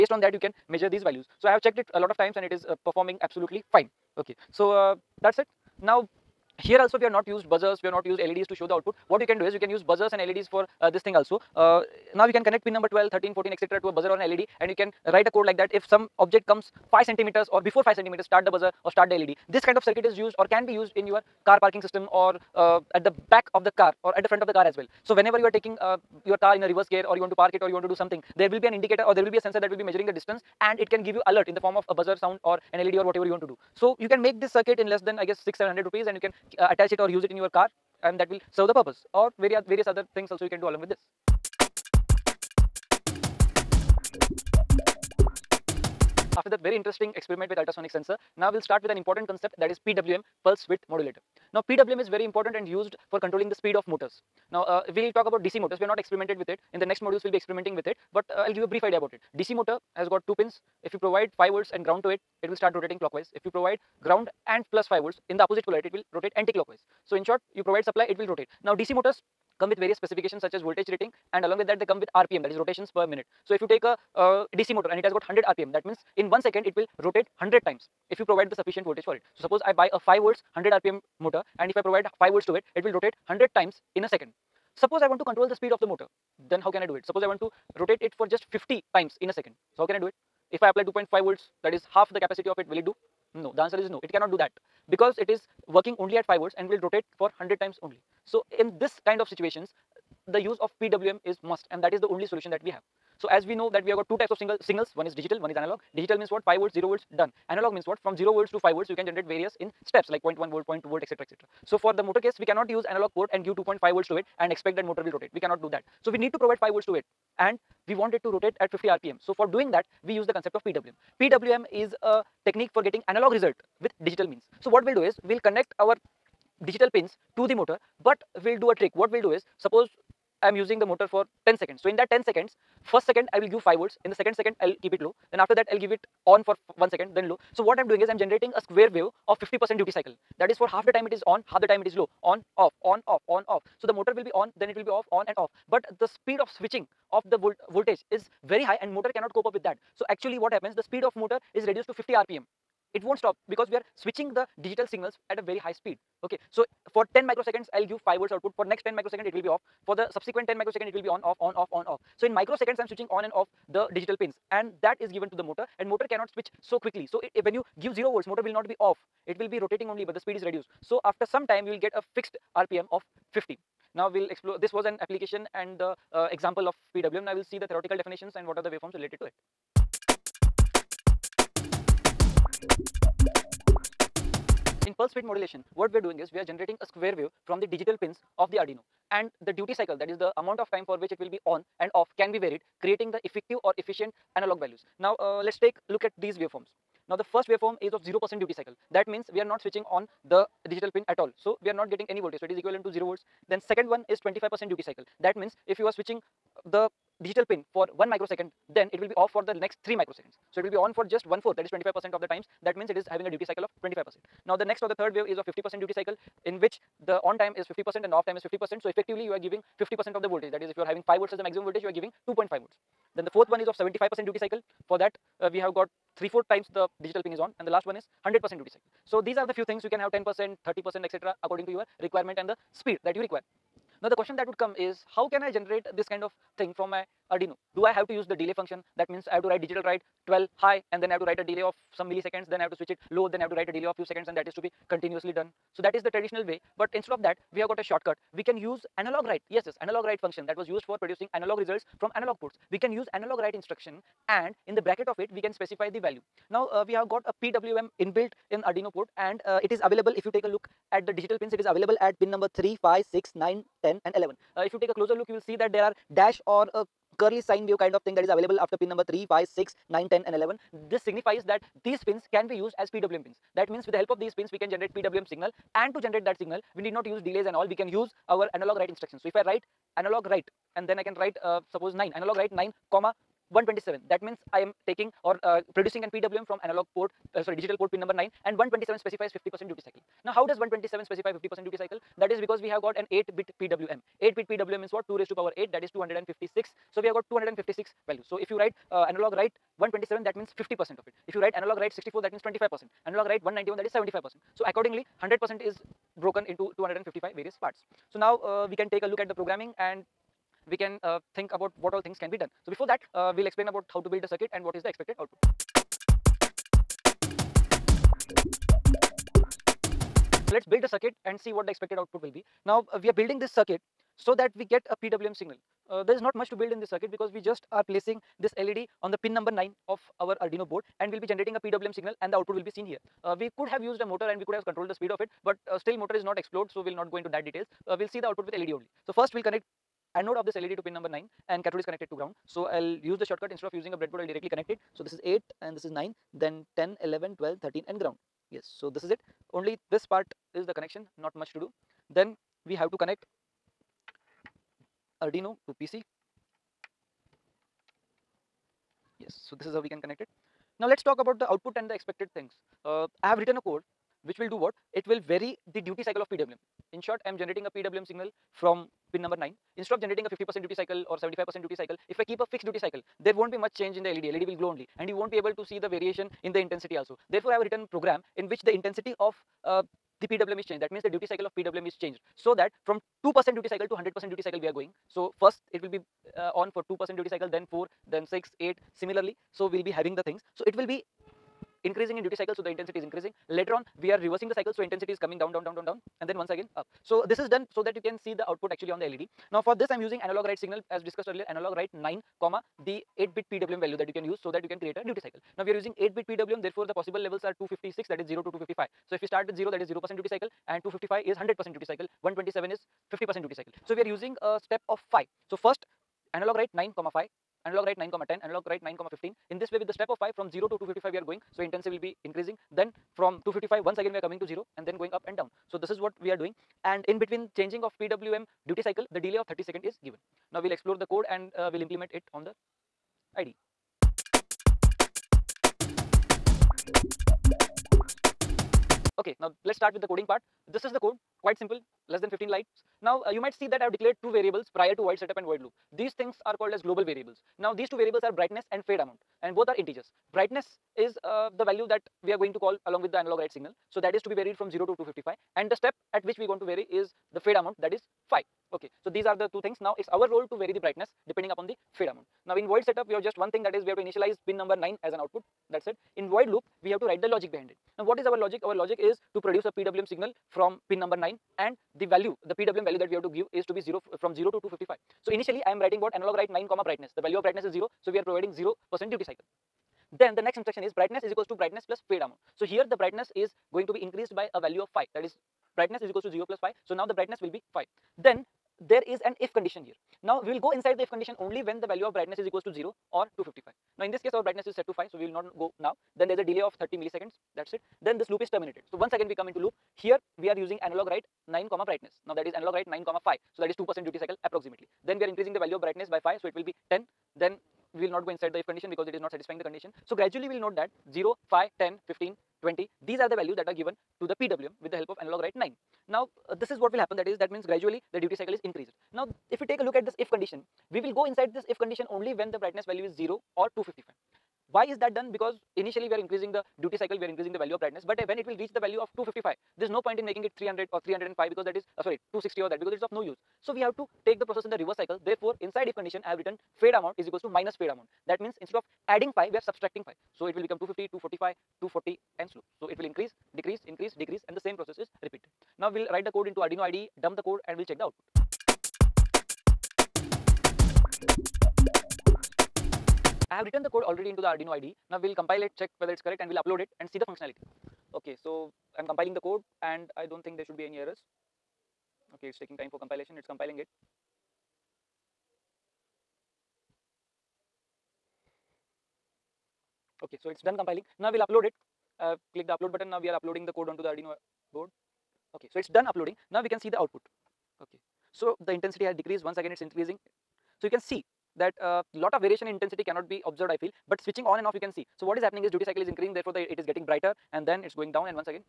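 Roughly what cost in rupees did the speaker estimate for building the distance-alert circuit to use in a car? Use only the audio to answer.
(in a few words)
700 rupees.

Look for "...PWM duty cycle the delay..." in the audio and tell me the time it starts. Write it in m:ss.
7:08.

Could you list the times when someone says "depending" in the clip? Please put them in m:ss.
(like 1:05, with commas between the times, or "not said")
7:41.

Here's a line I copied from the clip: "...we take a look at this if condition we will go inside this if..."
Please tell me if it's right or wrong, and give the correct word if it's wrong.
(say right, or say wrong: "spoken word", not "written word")
right.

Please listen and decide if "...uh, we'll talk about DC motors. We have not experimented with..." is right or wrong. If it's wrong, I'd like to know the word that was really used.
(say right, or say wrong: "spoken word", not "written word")
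right.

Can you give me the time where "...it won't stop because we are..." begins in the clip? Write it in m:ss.
2:32.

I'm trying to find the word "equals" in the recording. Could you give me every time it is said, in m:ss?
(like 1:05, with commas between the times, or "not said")
8:01, 8:06, 8:12, 8:57.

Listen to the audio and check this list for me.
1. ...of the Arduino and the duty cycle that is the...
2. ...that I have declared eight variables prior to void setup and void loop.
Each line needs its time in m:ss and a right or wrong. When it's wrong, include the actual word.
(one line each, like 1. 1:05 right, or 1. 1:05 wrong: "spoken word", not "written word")
1. 3:08 right
2. 7:23 wrong: "two", not "eight".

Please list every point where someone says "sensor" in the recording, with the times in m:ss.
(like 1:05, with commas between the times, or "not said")
0:29, 0:47.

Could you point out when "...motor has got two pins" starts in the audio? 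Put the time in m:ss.
0:59.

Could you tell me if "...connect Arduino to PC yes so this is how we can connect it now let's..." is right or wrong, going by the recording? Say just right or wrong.
right.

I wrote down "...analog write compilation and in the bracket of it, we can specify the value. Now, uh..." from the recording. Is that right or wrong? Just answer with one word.
wrong.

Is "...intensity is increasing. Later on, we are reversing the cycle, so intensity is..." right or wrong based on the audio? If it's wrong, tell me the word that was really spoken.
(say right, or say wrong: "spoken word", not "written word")
right.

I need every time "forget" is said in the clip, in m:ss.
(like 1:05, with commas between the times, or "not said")
not said.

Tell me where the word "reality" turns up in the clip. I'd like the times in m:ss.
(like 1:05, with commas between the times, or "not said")
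not said.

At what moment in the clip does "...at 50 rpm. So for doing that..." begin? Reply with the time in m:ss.
1:58.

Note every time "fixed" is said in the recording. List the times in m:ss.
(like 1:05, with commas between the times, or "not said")
2:52, 6:12.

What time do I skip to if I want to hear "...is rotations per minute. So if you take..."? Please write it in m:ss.
1:12.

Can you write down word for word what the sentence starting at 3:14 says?
Now uh, let's take look at these waveforms.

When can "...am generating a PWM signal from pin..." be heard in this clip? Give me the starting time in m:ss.
6:07.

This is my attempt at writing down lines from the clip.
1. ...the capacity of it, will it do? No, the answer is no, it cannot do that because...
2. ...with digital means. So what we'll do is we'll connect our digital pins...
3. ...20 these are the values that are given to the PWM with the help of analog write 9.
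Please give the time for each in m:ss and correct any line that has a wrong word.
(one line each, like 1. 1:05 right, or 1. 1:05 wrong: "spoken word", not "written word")
1. 1:32 right
2. 2:03 right
3. 8:32 right.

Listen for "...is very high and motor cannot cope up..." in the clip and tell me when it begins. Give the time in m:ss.
2:28.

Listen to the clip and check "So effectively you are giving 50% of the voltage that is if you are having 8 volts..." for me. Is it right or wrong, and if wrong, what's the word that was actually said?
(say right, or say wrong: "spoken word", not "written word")
wrong: "5", not "8".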